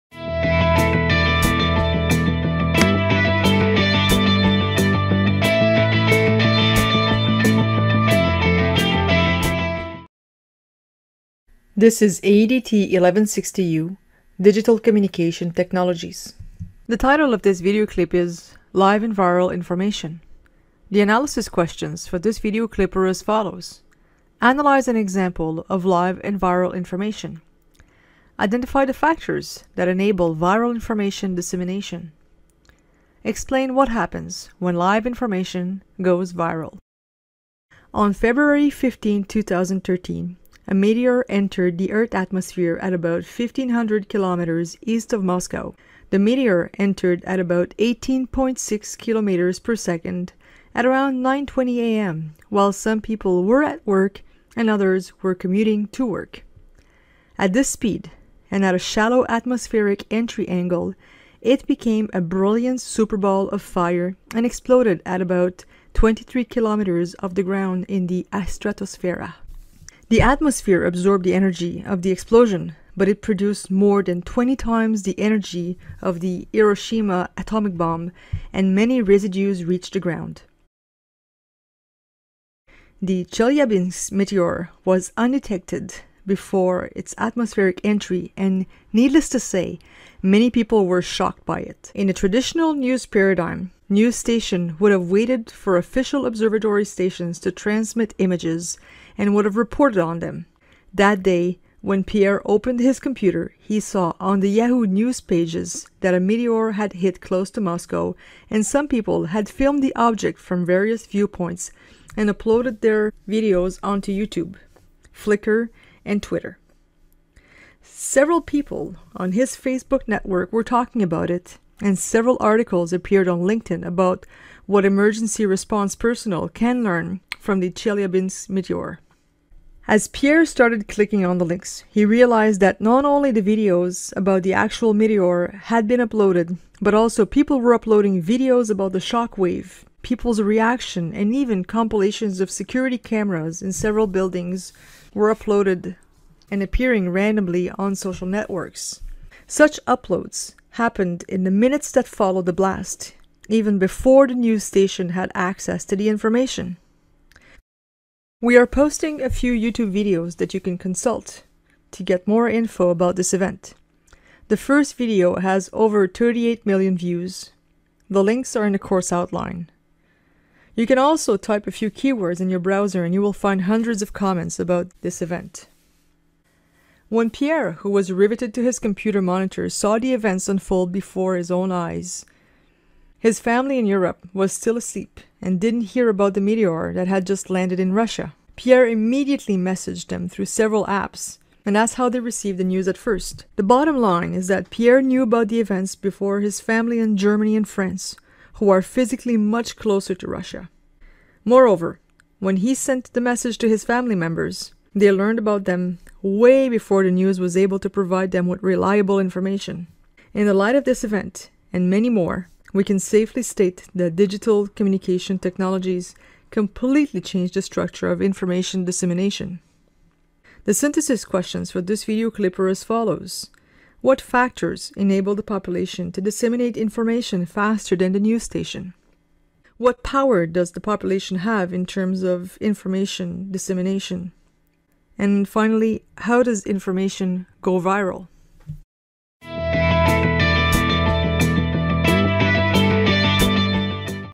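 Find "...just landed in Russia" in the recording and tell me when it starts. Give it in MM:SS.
03:07.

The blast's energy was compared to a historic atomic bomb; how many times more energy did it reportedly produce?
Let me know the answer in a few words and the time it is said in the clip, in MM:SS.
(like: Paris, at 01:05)
more than 20 times, at 01:13.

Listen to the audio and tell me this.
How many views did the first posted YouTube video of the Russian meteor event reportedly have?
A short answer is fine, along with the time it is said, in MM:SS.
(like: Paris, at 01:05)
over 38 million, at 02:45.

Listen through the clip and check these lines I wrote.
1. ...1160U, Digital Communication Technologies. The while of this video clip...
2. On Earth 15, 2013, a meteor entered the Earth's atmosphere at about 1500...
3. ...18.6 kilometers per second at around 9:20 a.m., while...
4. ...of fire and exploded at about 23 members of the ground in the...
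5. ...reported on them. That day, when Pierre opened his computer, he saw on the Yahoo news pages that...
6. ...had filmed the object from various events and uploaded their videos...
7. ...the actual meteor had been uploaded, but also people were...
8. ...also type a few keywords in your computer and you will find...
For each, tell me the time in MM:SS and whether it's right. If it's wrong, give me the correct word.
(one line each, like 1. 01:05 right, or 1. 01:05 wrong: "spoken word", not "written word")
1. 00:12 wrong: "title", not "while"
2. 00:37 wrong: "February", not "Earth"
3. 00:47 right
4. 01:03 wrong: "kilometers", not "members"
5. 01:39 right
6. 01:49 wrong: "viewpoints", not "events"
7. 02:14 right
8. 02:50 wrong: "browser", not "computer".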